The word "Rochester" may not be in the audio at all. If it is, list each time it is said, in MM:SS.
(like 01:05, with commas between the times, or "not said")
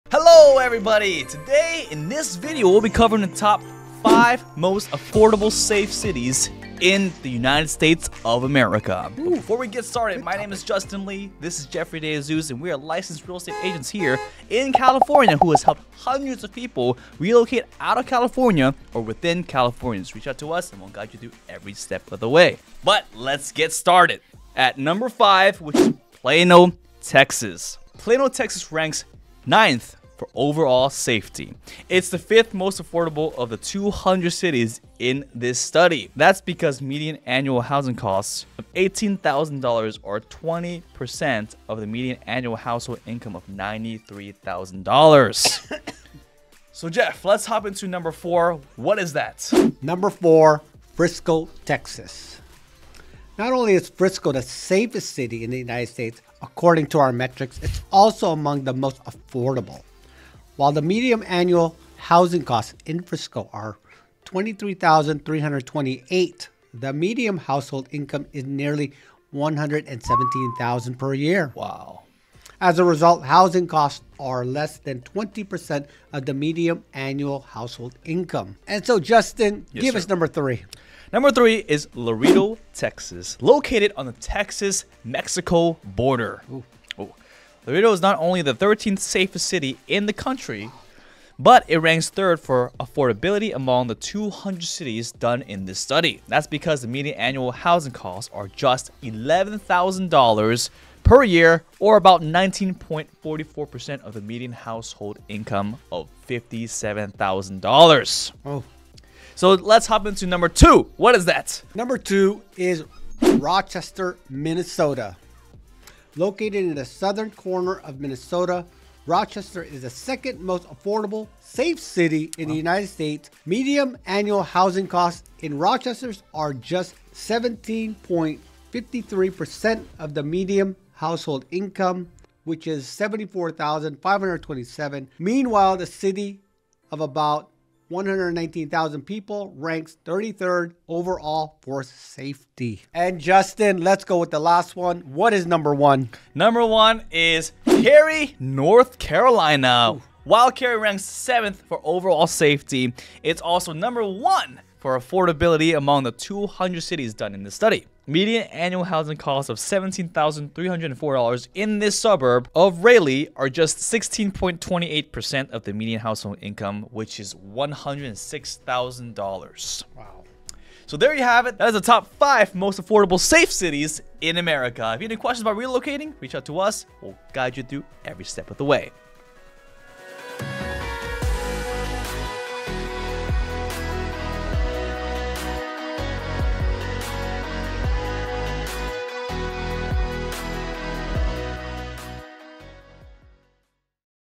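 01:53, 01:59, 02:05.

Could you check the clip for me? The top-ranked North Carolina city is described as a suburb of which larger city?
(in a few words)
Raleigh.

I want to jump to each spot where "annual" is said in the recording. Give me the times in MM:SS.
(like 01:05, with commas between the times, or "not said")
00:37, 00:42, 01:01, 01:16, 01:37, 02:04, 02:38.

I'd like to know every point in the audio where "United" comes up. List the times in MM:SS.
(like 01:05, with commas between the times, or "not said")
00:07, 00:55, 02:02.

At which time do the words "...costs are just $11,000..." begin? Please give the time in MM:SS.
01:37.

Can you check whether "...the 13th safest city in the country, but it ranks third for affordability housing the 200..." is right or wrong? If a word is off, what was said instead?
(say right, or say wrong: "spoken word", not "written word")
wrong: "among", not "housing".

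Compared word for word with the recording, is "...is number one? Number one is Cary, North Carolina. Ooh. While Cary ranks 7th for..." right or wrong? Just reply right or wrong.
right.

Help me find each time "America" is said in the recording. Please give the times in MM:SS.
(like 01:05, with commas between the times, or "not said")
00:08, 02:54.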